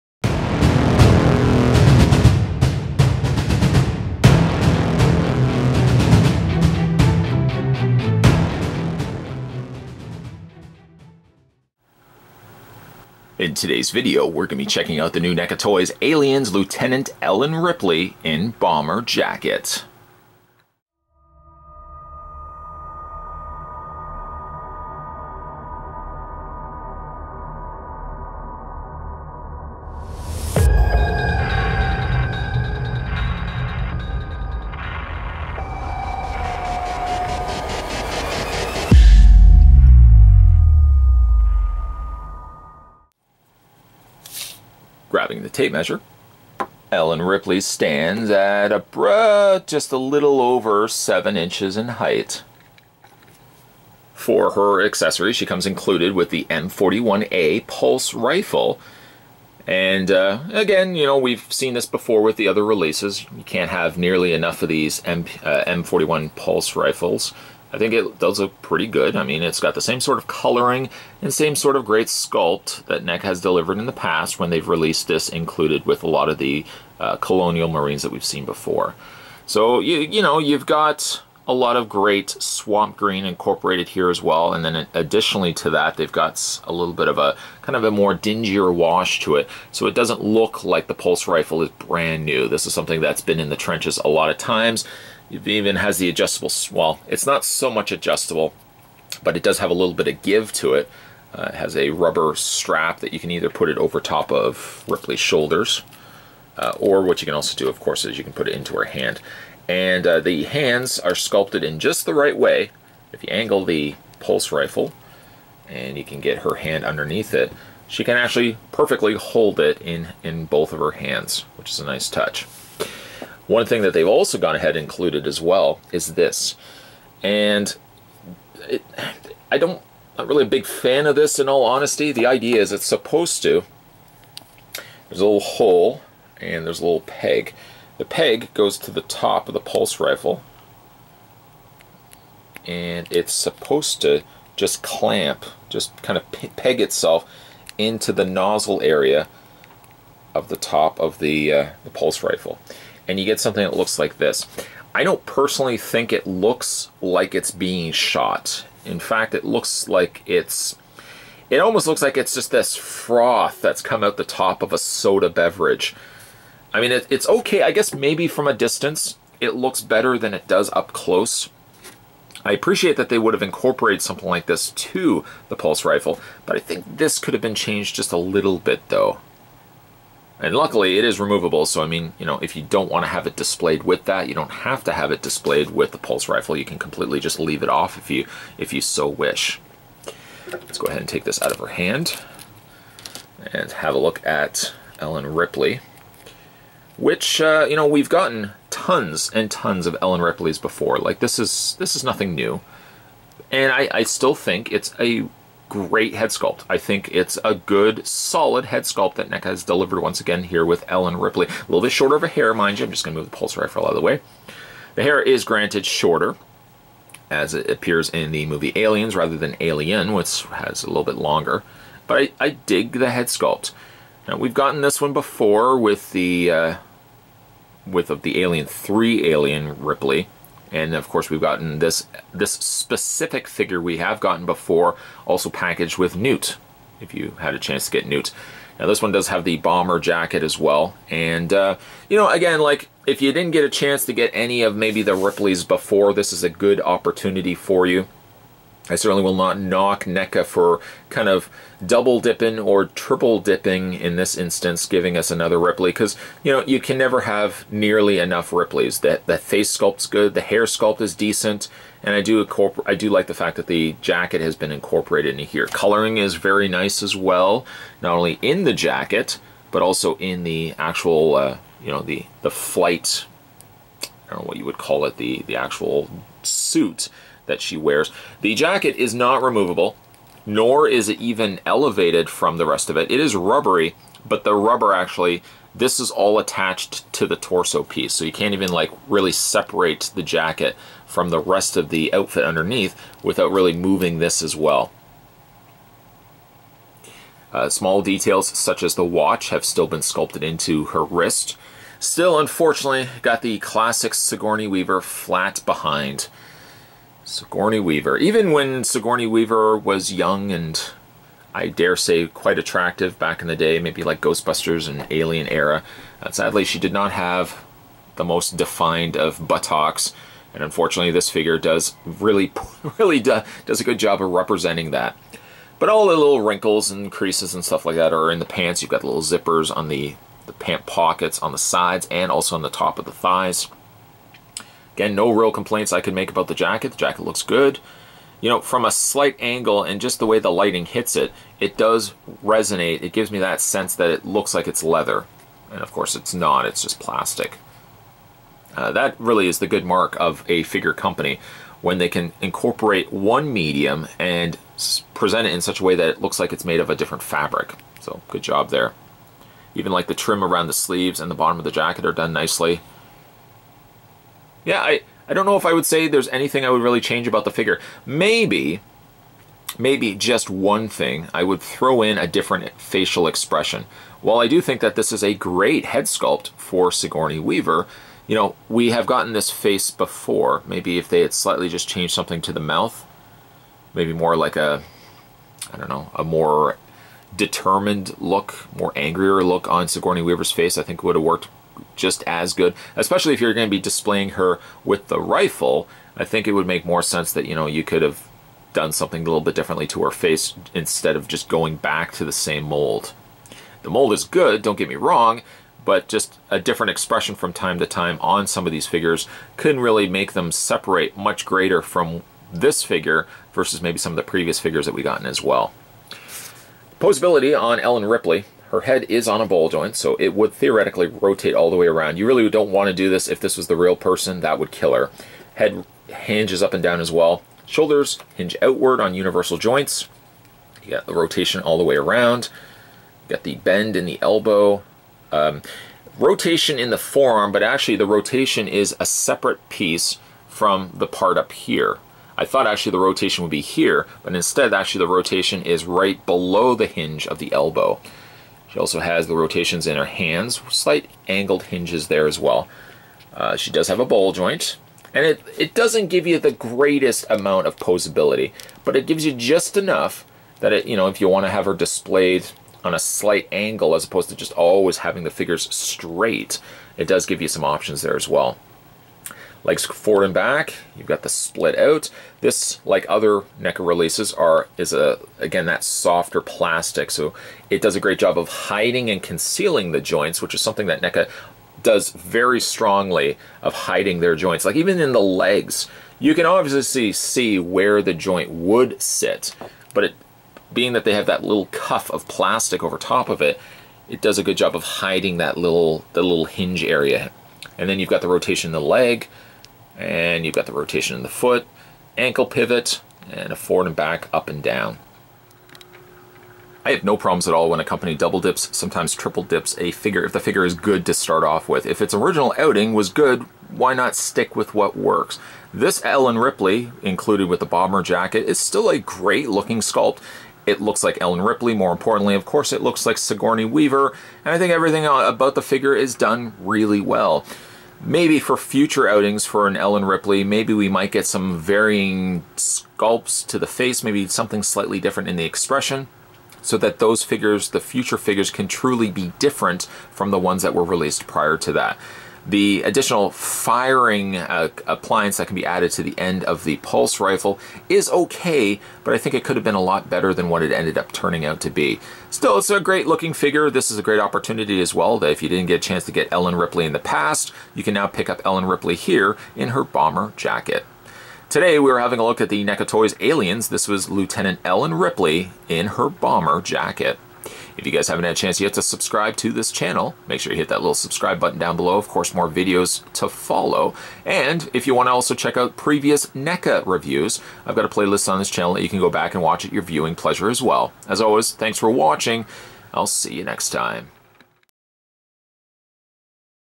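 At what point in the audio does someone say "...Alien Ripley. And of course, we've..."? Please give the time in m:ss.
3:49.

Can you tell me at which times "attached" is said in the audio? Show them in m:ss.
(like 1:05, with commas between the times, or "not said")
4:46.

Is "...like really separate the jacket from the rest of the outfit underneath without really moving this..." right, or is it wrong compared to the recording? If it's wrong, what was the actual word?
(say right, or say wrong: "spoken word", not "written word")
right.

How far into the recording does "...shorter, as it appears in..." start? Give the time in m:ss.
3:35.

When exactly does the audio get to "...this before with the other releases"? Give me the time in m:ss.
1:01.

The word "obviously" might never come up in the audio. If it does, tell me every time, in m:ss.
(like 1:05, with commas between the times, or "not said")
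8:06.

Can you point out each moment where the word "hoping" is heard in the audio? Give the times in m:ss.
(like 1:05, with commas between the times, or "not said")
not said.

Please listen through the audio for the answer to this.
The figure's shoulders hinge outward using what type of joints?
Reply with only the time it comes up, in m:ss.
7:09.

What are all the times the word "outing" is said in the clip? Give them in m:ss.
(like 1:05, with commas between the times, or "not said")
8:32, 8:49.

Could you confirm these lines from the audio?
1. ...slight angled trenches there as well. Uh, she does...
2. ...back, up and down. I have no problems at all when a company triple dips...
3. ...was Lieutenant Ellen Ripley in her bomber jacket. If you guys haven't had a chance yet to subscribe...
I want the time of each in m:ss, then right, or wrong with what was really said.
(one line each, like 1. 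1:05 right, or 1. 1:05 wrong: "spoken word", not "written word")
1. 7:30 wrong: "hinges", not "trenches"
2. 8:23 wrong: "double", not "triple"
3. 9:23 right.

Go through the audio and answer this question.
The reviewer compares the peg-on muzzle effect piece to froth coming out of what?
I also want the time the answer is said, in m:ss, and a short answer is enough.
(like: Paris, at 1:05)
a soda beverage, at 2:44.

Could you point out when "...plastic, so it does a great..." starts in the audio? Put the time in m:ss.
7:56.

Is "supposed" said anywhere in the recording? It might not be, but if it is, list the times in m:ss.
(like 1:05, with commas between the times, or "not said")
2:12, 2:23.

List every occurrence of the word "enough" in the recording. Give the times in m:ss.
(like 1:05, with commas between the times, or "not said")
1:04, 4:18, 7:39.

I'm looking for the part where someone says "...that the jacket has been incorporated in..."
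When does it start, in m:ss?
4:23.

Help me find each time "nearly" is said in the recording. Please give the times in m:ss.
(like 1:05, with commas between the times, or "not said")
1:03, 4:17.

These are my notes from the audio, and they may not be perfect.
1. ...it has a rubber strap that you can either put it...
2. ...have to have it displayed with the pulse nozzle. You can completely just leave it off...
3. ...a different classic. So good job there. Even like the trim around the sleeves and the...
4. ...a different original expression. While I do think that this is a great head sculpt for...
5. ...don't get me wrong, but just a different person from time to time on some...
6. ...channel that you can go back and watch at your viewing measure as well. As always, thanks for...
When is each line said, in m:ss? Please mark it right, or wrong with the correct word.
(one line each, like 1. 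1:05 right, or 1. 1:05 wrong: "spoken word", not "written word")
1. 1:41 right
2. 3:04 wrong: "rifle", not "nozzle"
3. 5:56 wrong: "fabric", not "classic"
4. 6:12 wrong: "facial", not "original"
5. 6:44 wrong: "expression", not "person"
6. 9:38 wrong: "pleasure", not "measure".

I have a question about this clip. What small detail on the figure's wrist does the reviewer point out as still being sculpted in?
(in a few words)
the watch.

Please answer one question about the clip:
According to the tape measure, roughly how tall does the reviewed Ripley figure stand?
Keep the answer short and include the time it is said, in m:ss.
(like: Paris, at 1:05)
a little over 7 inches, at 0:49.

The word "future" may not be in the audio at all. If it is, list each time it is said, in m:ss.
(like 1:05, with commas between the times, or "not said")
8:48, 8:57.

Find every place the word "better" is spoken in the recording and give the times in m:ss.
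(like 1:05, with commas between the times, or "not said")
2:49, 9:10.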